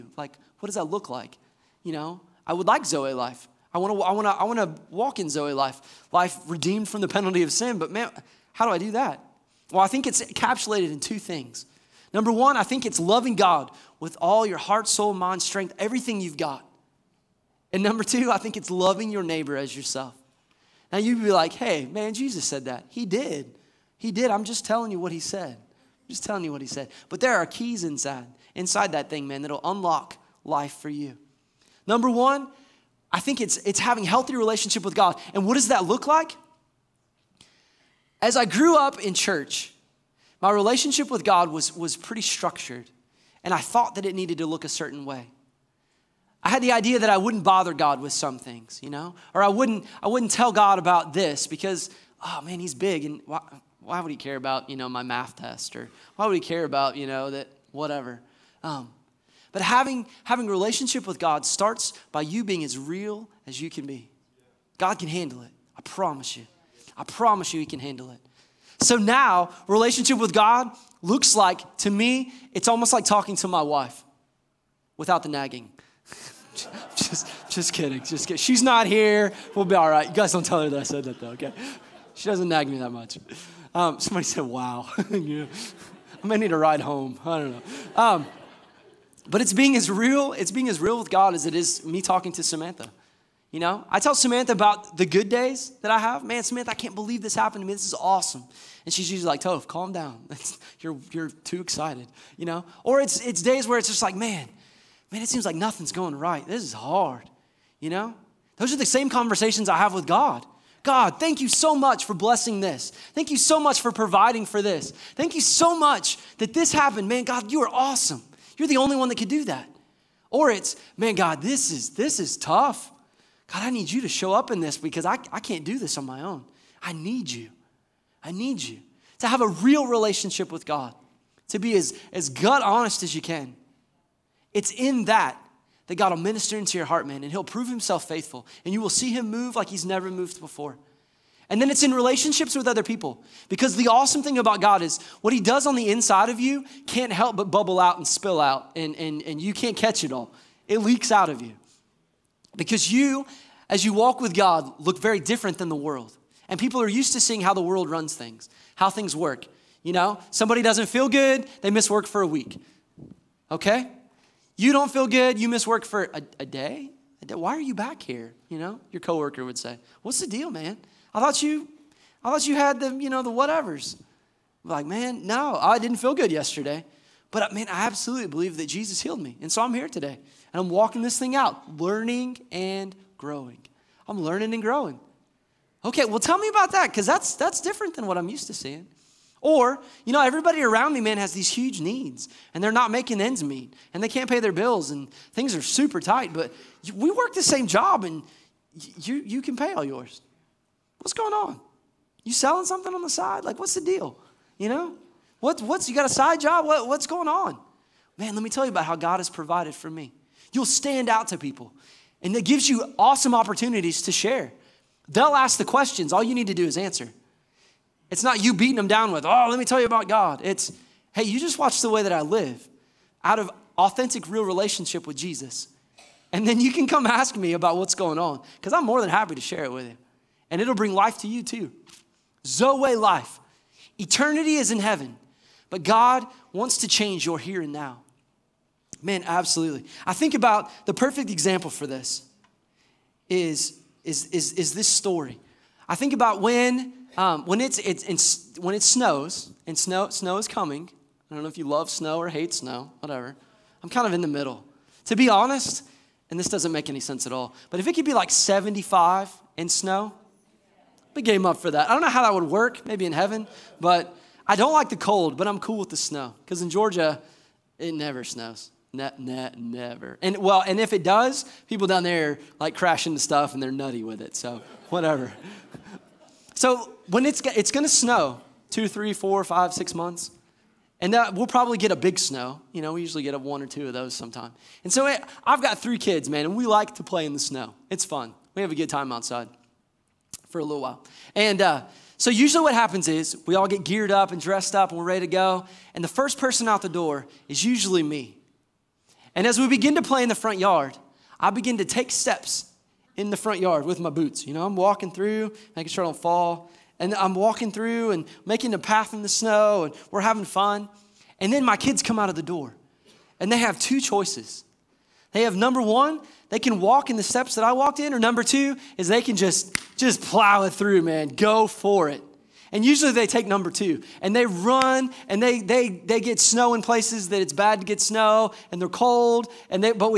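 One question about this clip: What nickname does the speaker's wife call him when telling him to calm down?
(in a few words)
Toph.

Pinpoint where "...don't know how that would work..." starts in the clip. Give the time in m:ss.
4:21.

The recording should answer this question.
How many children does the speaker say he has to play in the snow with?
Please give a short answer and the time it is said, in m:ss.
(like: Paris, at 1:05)
3, at 4:45.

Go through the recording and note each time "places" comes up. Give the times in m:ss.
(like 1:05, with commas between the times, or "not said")
5:26.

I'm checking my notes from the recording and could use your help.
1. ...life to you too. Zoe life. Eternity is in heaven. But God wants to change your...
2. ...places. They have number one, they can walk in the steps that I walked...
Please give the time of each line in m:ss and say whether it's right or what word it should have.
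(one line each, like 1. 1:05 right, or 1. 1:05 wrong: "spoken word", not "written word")
1. 3:50 right
2. 5:14 wrong: "choices", not "places".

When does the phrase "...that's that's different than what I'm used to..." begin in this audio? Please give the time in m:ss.
3:07.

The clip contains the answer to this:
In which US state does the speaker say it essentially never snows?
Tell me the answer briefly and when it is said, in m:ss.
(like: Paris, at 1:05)
Georgia, at 4:26.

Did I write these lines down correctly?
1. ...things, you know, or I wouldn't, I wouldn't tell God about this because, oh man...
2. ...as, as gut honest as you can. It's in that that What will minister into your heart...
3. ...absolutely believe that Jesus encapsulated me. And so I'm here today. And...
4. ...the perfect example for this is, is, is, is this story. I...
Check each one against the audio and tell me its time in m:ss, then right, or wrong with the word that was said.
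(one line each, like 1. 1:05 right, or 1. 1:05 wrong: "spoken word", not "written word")
1. 0:48 right
2. 2:11 wrong: "God", not "What"
3. 2:57 wrong: "healed", not "encapsulated"
4. 4:00 right.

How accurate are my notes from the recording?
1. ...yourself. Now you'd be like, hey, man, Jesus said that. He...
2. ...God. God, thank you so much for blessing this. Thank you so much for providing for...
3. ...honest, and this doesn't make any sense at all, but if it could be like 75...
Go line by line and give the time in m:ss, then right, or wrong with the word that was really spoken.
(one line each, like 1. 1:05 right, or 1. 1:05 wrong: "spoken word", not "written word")
1. 0:19 right
2. 1:50 right
3. 4:15 right.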